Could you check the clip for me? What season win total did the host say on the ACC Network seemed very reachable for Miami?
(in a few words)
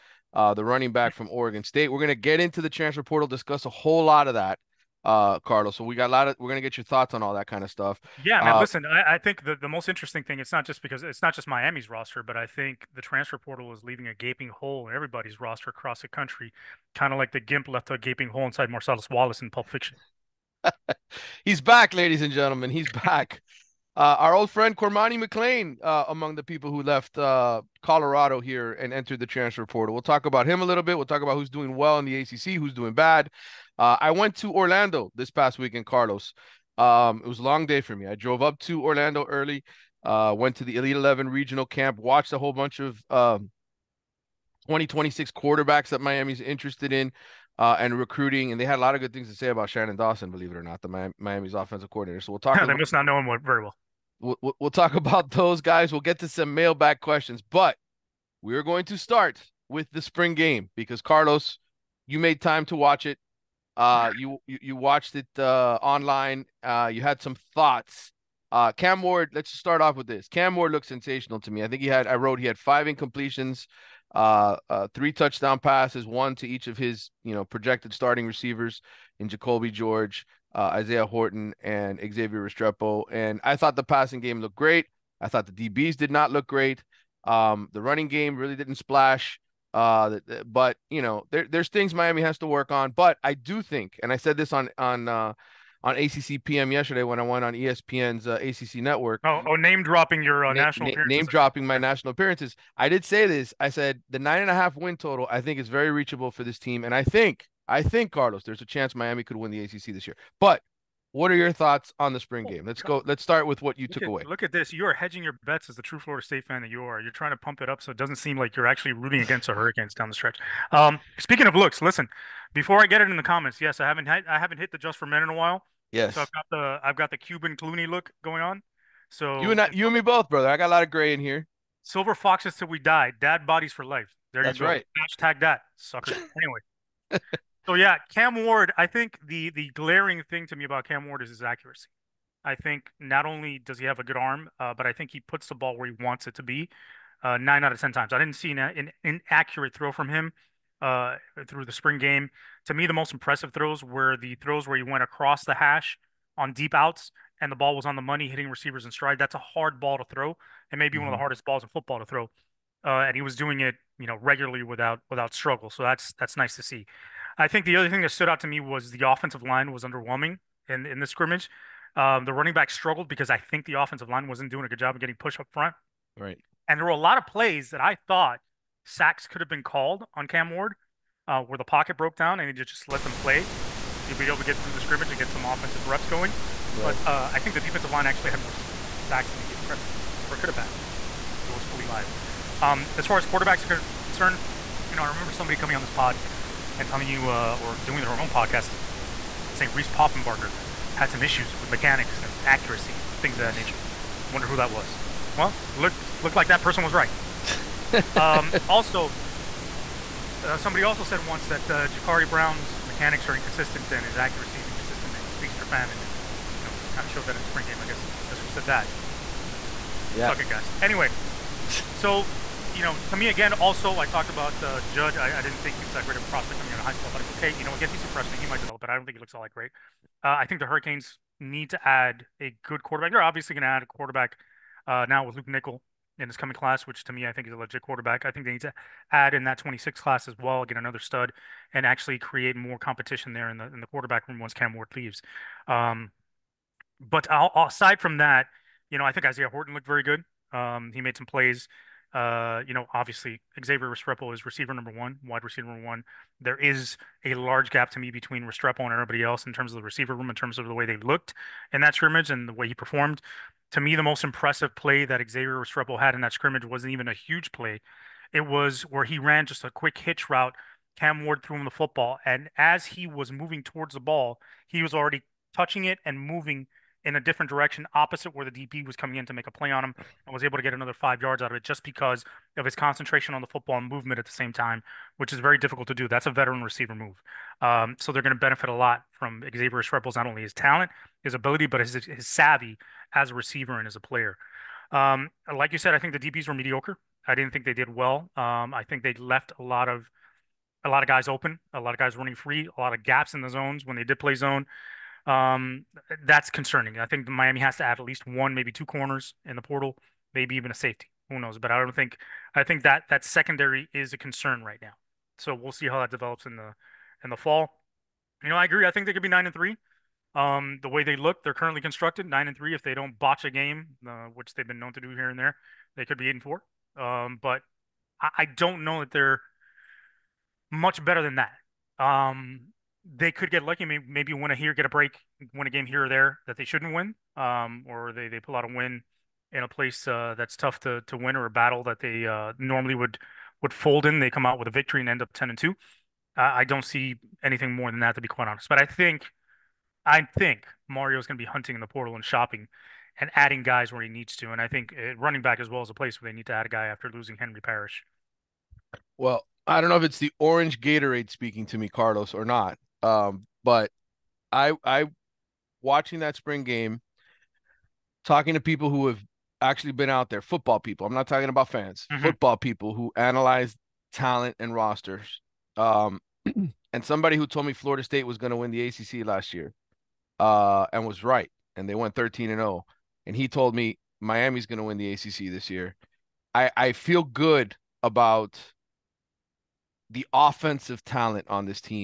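9.5.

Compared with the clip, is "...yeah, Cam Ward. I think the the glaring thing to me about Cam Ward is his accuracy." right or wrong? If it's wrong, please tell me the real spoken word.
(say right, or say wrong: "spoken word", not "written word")
right.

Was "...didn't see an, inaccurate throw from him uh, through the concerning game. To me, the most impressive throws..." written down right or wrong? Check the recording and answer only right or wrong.
wrong.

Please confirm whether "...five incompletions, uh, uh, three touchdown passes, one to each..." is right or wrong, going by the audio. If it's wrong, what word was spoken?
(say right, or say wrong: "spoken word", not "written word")
right.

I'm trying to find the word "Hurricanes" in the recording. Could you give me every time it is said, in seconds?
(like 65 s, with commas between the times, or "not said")
119 s, 230 s.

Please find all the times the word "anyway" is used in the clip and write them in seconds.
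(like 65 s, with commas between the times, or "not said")
136 s, 220 s.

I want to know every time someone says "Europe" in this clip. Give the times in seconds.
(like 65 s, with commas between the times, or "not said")
not said.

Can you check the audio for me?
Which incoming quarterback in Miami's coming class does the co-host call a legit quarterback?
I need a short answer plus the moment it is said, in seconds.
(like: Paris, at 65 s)
Luke Nickel, at 235 s.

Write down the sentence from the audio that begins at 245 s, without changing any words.
Um, but I'll, aside from that, you know, I think Isaiah Horton looked very good.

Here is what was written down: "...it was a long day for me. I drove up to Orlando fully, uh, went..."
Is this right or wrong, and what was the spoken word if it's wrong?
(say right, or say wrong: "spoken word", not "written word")
wrong: "early", not "fully".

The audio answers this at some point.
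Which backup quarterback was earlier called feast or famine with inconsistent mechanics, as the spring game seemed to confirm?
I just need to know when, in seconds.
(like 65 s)
211 s.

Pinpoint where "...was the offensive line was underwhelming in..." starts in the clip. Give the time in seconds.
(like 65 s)
168 s.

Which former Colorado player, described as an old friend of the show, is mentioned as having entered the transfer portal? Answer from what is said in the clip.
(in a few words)
Cormani McClain.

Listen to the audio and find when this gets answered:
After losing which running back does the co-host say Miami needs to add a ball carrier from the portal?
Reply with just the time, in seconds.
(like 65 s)
357 s.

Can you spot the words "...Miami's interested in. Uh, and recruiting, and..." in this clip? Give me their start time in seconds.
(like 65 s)
45 s.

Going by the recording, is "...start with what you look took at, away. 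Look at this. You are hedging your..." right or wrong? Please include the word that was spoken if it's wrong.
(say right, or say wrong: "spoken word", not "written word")
right.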